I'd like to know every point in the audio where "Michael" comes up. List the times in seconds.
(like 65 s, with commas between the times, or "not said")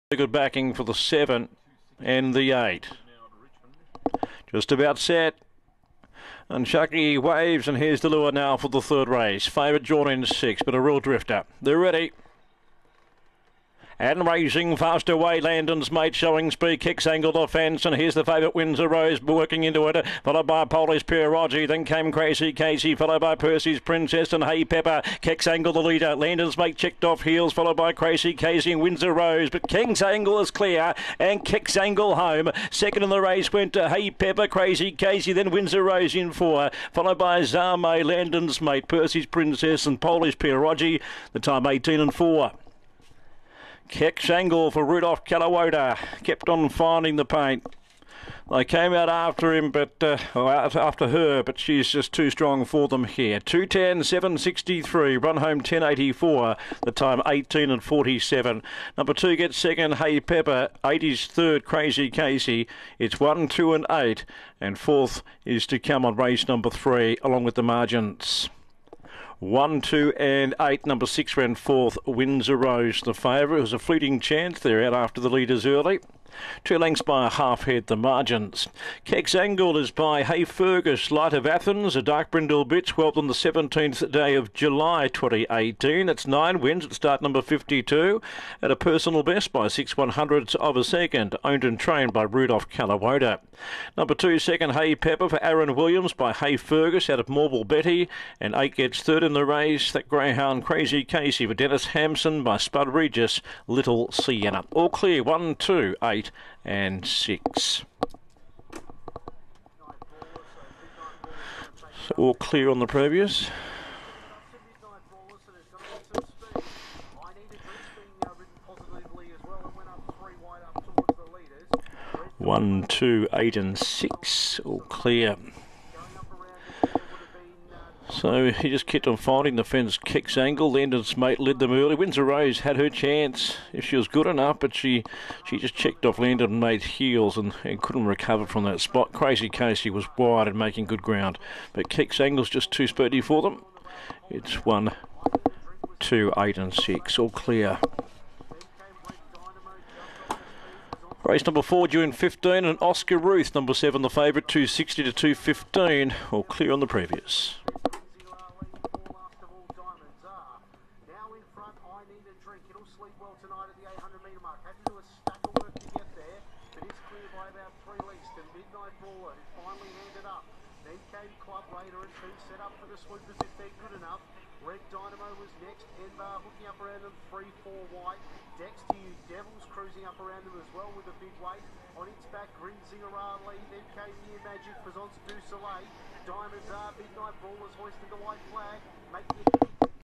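not said.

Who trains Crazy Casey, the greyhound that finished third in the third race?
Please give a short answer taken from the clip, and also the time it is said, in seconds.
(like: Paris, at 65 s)
Dennis Hampson, at 101 s.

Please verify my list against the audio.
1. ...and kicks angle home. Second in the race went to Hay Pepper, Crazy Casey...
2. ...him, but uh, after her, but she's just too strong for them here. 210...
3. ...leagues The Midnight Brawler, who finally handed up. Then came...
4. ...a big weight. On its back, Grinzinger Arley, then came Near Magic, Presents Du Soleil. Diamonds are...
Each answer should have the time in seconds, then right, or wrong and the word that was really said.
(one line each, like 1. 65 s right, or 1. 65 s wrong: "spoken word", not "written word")
1. 31 s right
2. 49 s right
3. 168 s right
4. 181 s right.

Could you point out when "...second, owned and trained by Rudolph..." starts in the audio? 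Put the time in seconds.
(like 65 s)
90 s.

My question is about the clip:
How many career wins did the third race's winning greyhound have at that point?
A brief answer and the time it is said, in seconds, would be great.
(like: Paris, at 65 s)
9, at 86 s.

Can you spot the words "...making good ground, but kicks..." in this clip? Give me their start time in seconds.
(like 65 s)
140 s.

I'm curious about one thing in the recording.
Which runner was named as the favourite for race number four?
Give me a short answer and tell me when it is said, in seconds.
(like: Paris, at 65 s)
Oscar Ruth, at 152 s.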